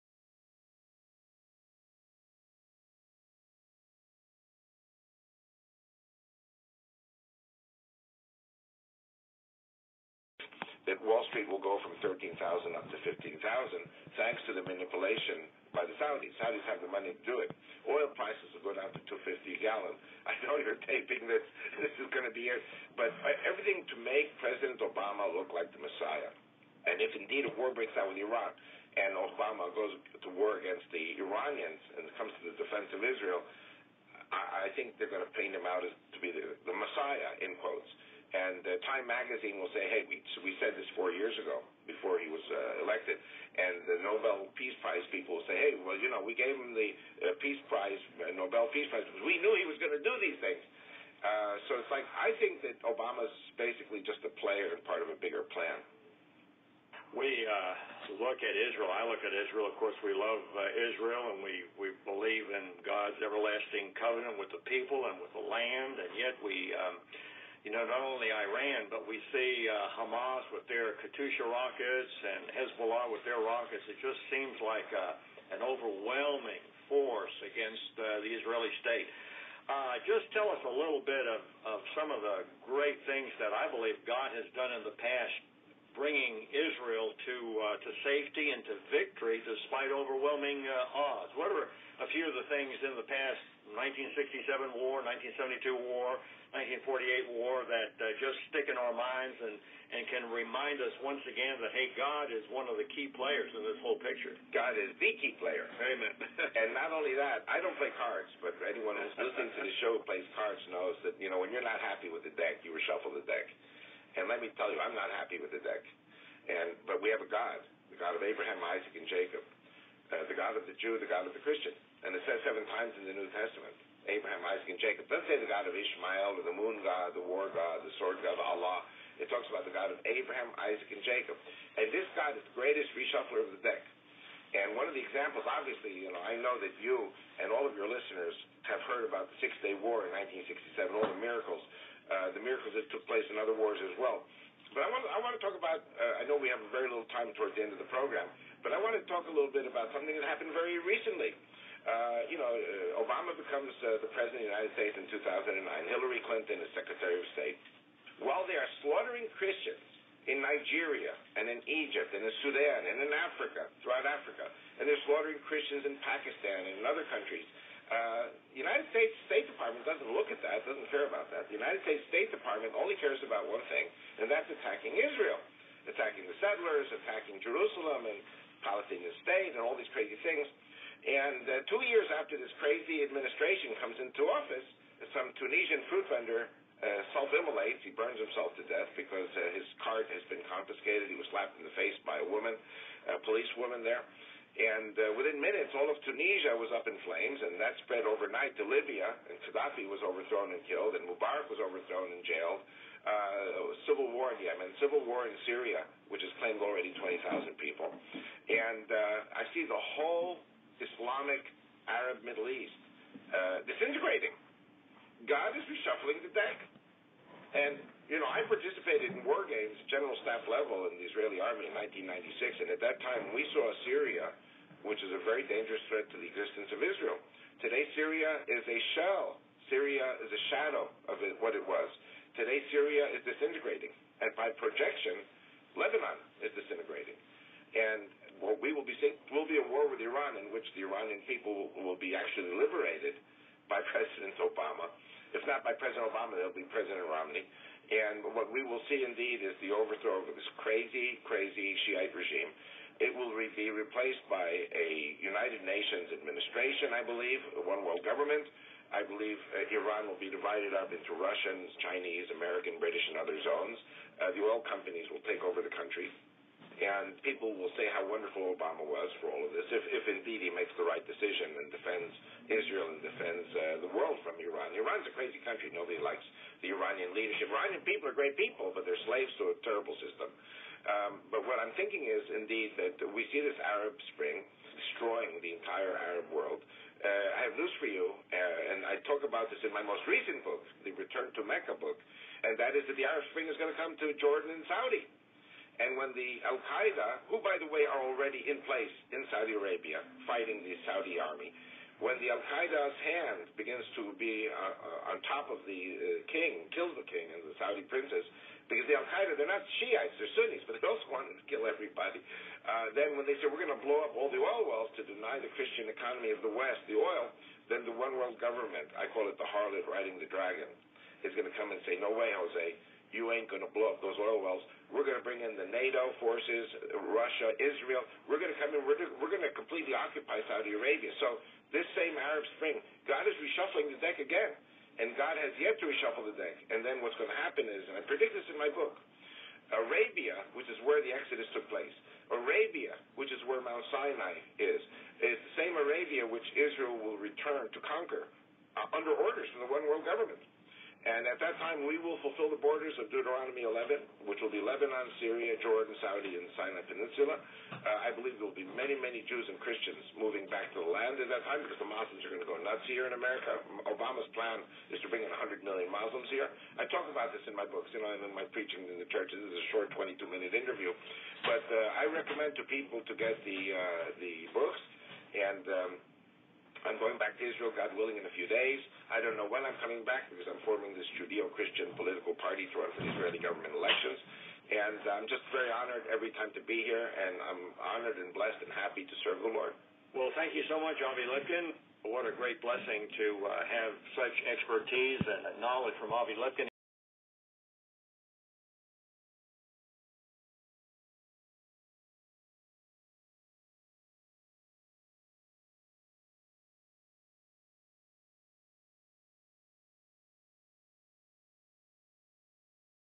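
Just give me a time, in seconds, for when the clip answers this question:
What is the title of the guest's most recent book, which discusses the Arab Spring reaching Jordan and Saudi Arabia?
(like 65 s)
290 s.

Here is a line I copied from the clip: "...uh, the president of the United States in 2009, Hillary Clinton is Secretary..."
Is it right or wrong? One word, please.
right.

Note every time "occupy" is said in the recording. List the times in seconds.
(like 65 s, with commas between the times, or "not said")
329 s.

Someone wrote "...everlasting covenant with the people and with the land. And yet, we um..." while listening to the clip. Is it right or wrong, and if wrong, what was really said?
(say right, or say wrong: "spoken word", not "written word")
right.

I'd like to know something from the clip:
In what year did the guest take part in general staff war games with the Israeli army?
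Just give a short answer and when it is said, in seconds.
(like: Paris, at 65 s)
1996, at 221 s.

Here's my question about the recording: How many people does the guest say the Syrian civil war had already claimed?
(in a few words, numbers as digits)
20,000.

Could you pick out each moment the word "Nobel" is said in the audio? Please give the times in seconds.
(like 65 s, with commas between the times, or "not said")
44 s, 48 s.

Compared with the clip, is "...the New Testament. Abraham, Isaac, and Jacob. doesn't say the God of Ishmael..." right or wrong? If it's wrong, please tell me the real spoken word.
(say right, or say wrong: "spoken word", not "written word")
right.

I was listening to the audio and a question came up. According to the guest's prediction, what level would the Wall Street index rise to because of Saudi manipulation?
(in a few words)
15,000.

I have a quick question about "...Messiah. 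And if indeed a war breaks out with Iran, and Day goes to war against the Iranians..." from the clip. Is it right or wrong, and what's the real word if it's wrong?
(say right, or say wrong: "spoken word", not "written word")
wrong: "Obama", not "Day".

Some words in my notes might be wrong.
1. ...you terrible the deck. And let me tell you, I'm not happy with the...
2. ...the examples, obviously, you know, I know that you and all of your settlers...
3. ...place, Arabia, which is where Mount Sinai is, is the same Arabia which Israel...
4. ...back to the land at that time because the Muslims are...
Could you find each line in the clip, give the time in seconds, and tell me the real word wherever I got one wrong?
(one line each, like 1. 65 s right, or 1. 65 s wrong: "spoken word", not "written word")
1. 112 s wrong: "reshuffle", not "terrible"
2. 134 s wrong: "listeners", not "settlers"
3. 341 s right
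4. 360 s right.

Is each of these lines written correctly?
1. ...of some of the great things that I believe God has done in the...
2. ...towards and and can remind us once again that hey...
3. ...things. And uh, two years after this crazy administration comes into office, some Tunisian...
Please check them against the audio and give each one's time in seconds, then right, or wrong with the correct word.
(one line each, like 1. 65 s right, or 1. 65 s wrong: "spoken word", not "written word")
1. 81 s right
2. 98 s wrong: "minds", not "towards"
3. 180 s right.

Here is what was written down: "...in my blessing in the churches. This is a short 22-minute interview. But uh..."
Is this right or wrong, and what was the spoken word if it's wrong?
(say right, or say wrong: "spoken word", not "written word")
wrong: "preaching", not "blessing".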